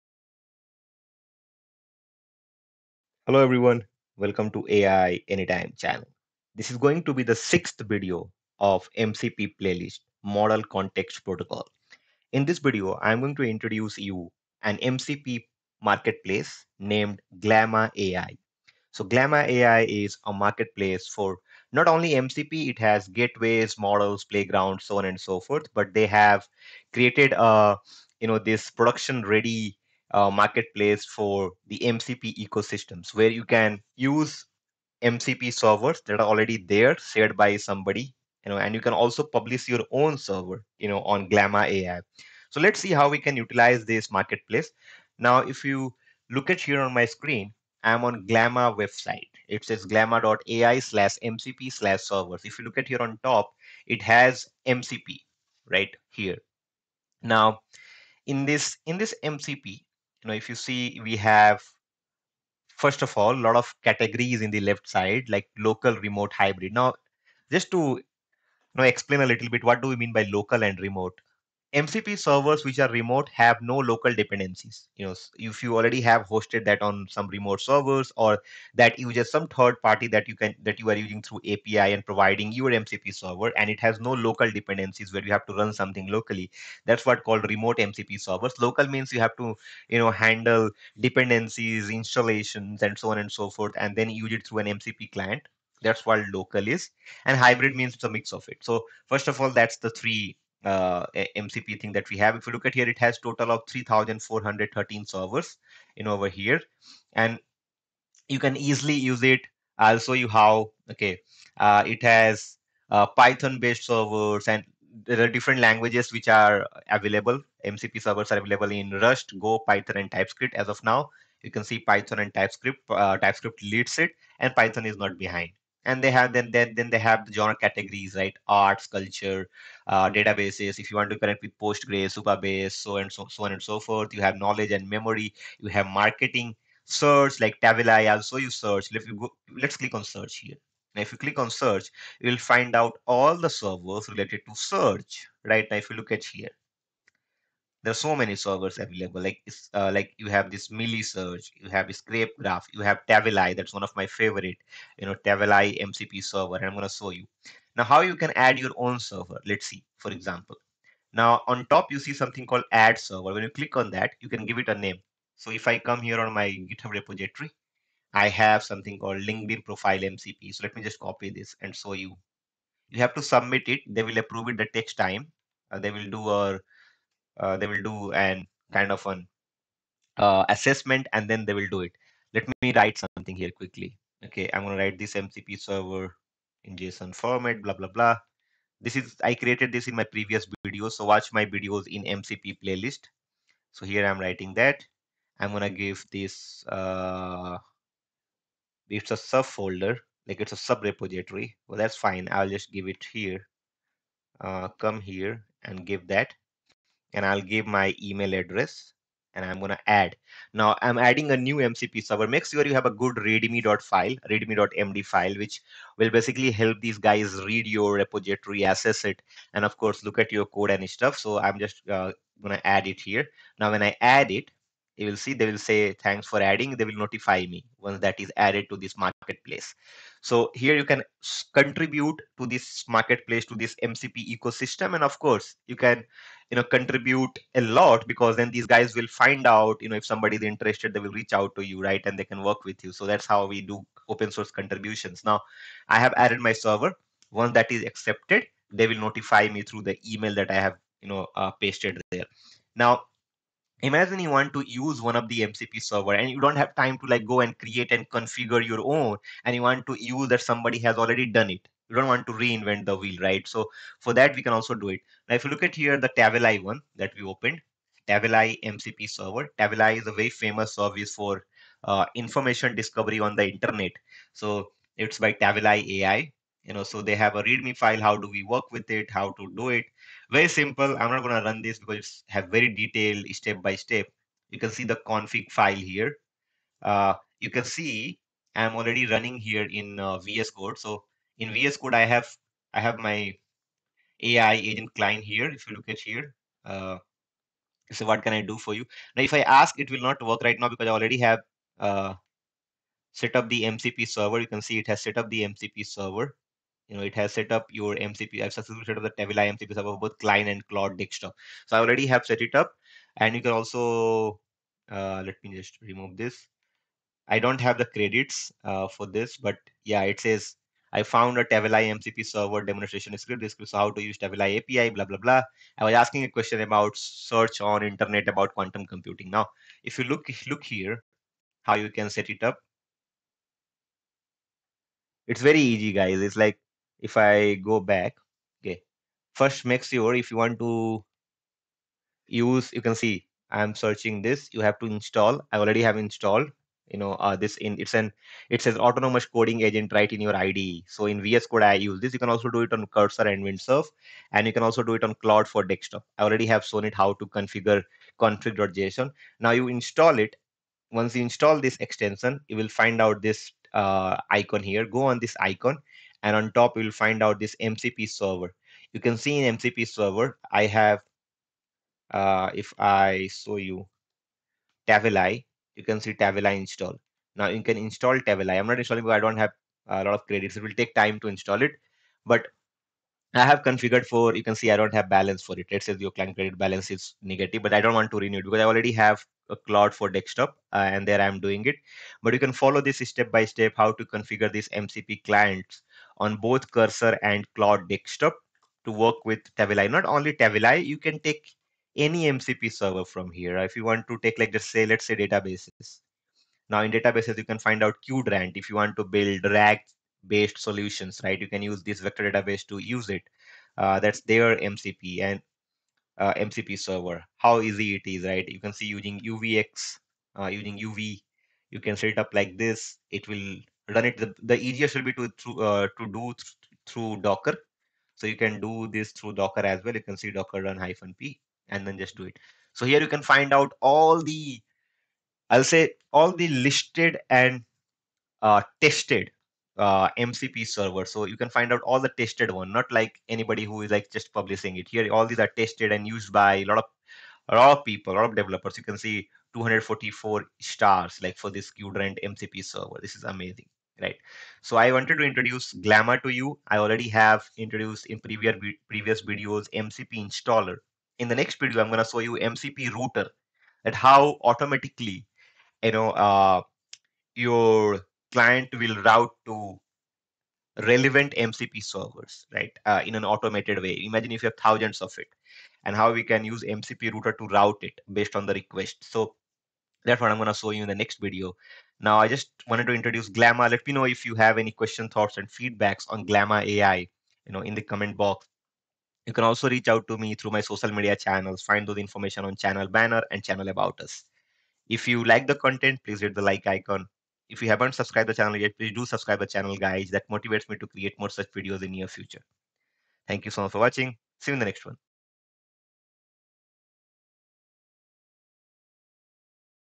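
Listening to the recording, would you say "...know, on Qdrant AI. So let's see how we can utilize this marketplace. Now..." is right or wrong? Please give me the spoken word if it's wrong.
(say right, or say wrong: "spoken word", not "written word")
wrong: "Glama", not "Qdrant".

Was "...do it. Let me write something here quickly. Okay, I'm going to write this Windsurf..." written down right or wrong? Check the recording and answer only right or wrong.
wrong.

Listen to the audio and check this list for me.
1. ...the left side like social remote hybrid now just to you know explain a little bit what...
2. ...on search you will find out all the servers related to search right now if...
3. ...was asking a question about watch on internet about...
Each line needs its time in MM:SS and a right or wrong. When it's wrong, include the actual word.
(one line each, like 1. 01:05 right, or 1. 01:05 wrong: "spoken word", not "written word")
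1. 01:04 wrong: "local", not "social"
2. 02:21 right
3. 05:25 wrong: "search", not "watch".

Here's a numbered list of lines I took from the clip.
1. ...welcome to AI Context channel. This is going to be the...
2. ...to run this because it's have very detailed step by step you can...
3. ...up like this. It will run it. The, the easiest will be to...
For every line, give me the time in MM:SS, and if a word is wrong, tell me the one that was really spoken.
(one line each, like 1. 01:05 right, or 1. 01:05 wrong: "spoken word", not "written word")
1. 00:04 wrong: "Anytime", not "Context"
2. 04:41 right
3. 07:02 right.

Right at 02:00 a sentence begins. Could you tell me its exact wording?
As of now, you can see Python and TypeScript.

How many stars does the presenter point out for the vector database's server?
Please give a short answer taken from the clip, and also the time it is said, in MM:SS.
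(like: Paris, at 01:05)
244, at 07:29.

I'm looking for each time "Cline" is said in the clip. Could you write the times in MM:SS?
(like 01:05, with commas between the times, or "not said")
05:10, 06:26.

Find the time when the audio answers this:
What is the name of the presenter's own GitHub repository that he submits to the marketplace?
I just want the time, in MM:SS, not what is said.
02:49.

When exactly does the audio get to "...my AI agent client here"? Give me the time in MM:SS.
04:52.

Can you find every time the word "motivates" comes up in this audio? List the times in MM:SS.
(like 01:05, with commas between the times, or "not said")
08:20.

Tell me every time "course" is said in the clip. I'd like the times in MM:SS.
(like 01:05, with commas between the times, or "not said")
03:39, 03:55.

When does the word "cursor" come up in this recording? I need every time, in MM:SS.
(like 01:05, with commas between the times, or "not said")
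05:52, 06:36.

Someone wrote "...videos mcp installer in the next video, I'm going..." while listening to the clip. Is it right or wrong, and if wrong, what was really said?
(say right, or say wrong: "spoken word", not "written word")
right.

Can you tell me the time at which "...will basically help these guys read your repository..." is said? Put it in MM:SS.
03:35.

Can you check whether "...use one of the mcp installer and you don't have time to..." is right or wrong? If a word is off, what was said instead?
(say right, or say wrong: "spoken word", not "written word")
wrong: "server", not "installer".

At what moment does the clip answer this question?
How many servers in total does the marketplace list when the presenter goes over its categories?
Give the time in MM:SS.
01:43.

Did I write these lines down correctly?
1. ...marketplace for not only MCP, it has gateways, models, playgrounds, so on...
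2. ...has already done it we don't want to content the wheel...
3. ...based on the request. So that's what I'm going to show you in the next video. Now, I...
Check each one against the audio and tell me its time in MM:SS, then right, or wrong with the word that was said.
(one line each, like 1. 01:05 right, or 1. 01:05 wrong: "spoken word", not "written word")
1. 00:20 right
2. 04:20 wrong: "reinvent", not "content"
3. 07:58 right.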